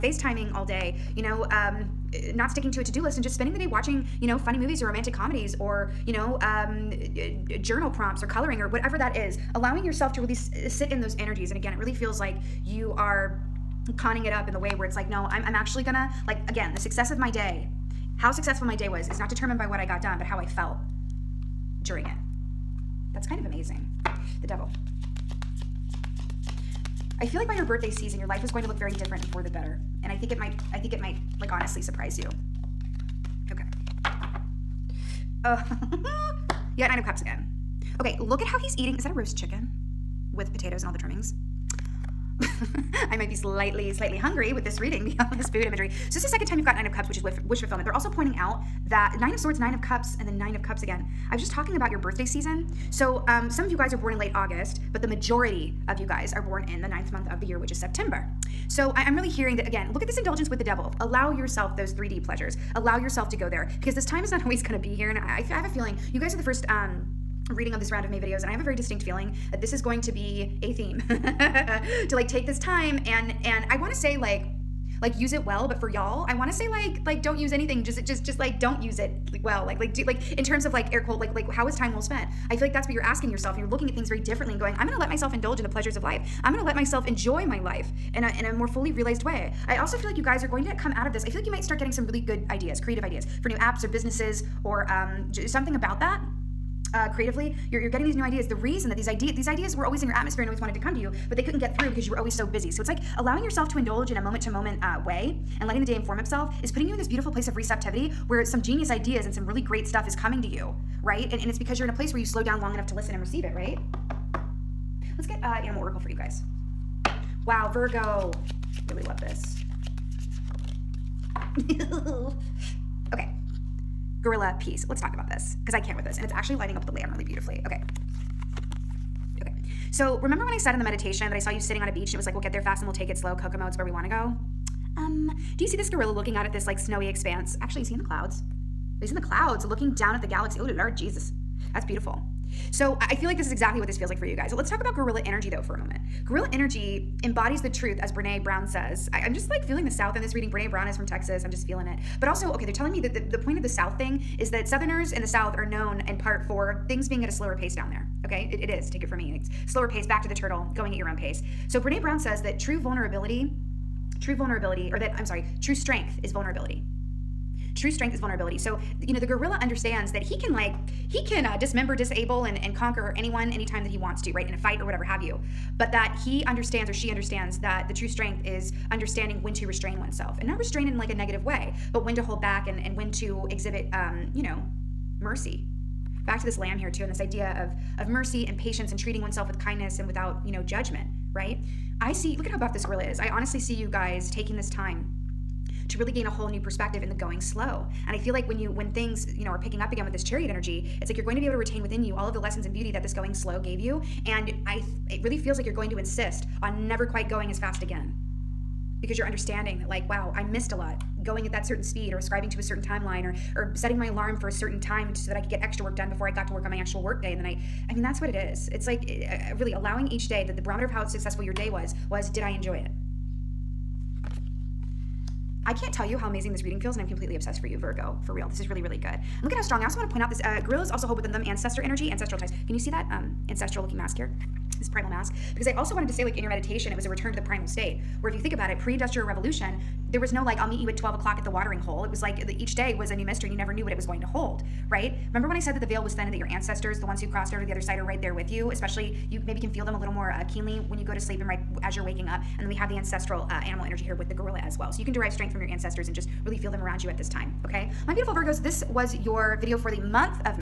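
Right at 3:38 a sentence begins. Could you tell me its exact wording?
It's like eh, eh, really allowing each day that the barometer of how successful your day was was did I enjoy it?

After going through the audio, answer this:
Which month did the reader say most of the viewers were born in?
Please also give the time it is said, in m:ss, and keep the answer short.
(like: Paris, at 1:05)
September, at 0:57.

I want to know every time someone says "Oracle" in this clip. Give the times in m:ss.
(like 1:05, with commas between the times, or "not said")
1:55.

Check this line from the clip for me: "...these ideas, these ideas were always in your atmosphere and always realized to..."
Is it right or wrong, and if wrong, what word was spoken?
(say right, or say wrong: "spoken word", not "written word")
wrong: "wanted", not "realized".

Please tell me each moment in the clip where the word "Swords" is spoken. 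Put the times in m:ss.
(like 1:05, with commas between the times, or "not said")
0:49.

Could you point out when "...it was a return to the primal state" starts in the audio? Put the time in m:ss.
3:56.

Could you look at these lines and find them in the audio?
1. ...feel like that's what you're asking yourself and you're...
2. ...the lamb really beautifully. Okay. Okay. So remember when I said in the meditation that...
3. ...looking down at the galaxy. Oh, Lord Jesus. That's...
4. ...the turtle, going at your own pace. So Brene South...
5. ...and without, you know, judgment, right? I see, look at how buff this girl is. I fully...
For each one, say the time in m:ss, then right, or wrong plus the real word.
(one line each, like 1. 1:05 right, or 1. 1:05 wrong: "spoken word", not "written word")
1. 1:22 right
2. 2:06 right
3. 2:19 right
4. 2:40 wrong: "Brown", not "South"
5. 3:09 wrong: "honestly", not "fully".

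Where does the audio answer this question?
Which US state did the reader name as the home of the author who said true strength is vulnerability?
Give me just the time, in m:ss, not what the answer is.
2:31.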